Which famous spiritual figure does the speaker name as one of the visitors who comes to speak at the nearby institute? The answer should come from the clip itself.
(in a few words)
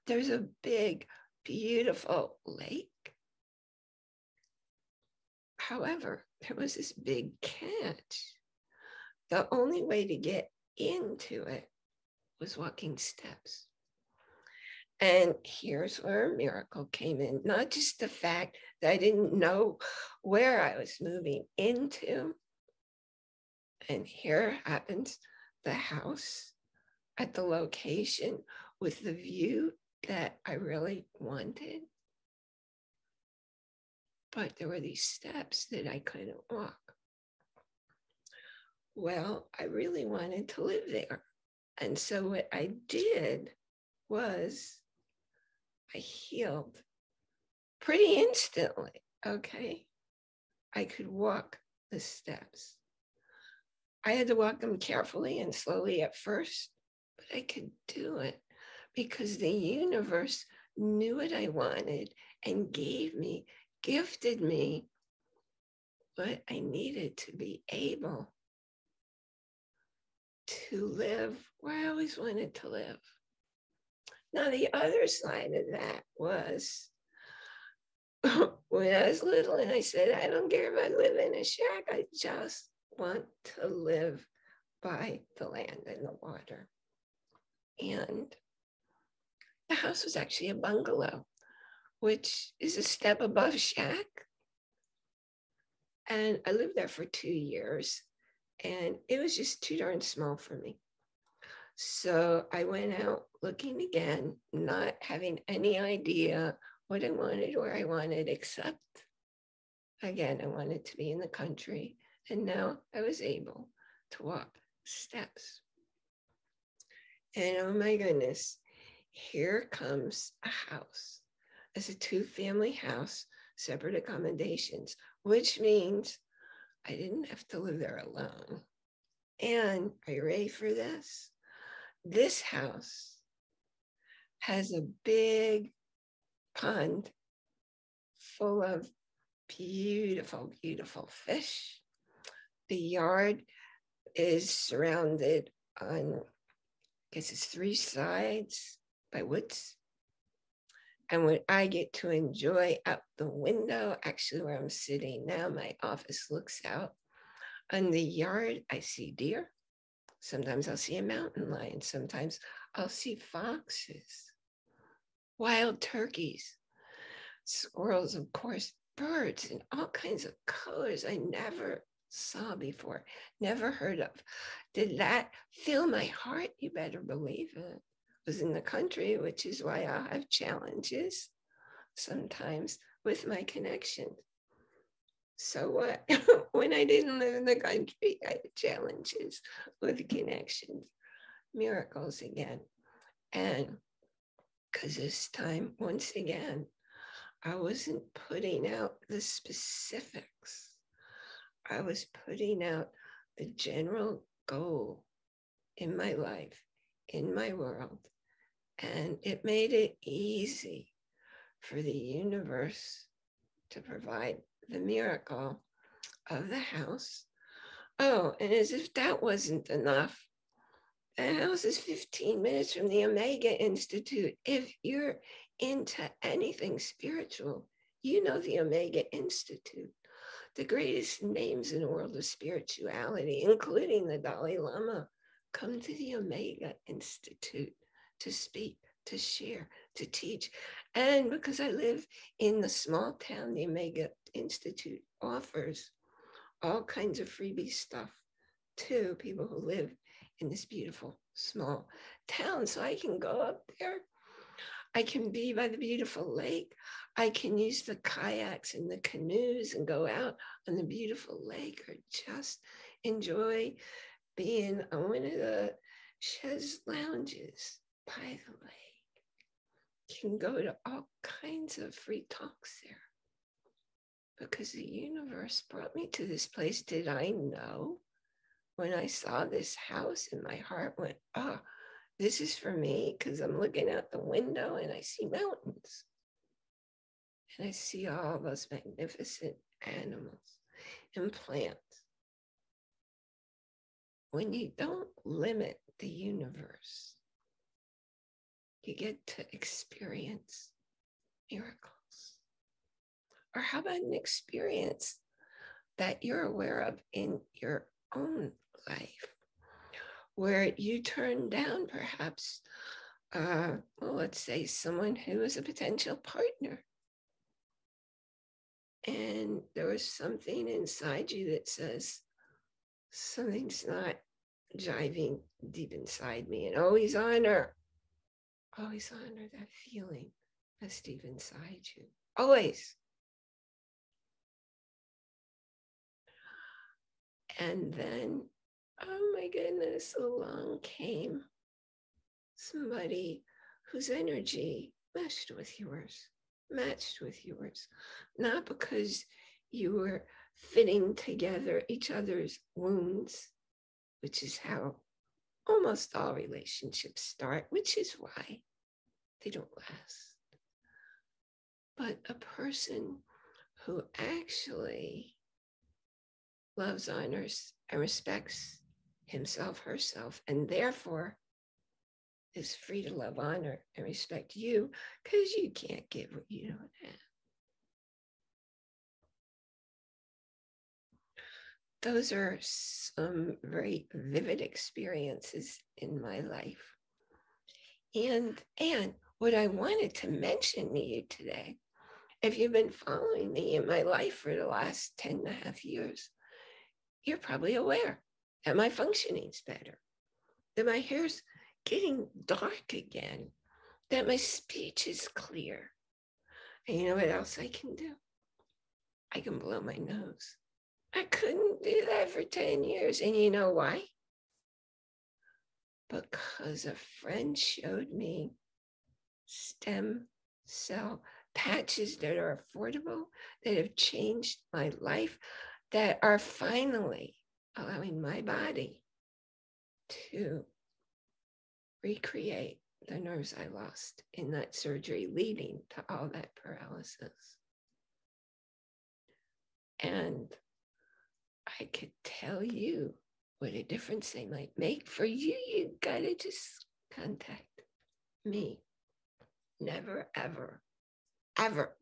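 The Dalai Lama.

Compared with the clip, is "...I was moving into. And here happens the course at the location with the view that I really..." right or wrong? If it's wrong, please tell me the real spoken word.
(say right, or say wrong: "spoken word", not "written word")
wrong: "house", not "course".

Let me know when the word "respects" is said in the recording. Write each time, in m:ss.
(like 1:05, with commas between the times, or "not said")
6:07, 6:14.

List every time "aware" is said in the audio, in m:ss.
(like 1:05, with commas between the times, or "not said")
5:06, 6:37.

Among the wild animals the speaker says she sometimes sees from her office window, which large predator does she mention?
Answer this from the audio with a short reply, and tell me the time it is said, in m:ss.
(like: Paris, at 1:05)
Mountain lion, at 2:41.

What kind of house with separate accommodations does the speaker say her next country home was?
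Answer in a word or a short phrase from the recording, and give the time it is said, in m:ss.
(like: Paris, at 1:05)
Two family house, at 2:01.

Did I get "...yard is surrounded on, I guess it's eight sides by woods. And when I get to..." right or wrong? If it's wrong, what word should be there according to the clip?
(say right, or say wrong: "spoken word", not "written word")
wrong: "three", not "eight".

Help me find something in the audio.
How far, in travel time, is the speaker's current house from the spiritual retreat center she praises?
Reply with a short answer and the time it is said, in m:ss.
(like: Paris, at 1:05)
15 minutes, at 3:41.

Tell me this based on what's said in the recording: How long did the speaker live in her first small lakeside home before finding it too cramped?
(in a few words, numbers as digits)
2 years.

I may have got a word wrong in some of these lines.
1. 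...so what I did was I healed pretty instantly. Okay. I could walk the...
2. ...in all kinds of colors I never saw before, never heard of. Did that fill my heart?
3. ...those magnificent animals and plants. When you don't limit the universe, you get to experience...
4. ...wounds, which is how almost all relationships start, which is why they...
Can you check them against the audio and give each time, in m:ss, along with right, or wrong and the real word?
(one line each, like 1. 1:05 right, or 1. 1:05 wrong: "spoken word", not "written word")
1. 0:41 right
2. 2:49 right
3. 4:48 right
4. 5:52 right.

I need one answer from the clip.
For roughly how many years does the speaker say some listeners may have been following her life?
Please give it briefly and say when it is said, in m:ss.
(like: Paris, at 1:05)
10.5 years, at 6:35.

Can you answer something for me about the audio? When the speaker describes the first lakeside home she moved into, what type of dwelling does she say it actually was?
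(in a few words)
Bungalow.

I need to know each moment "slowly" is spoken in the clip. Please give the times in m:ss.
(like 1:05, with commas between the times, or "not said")
0:55.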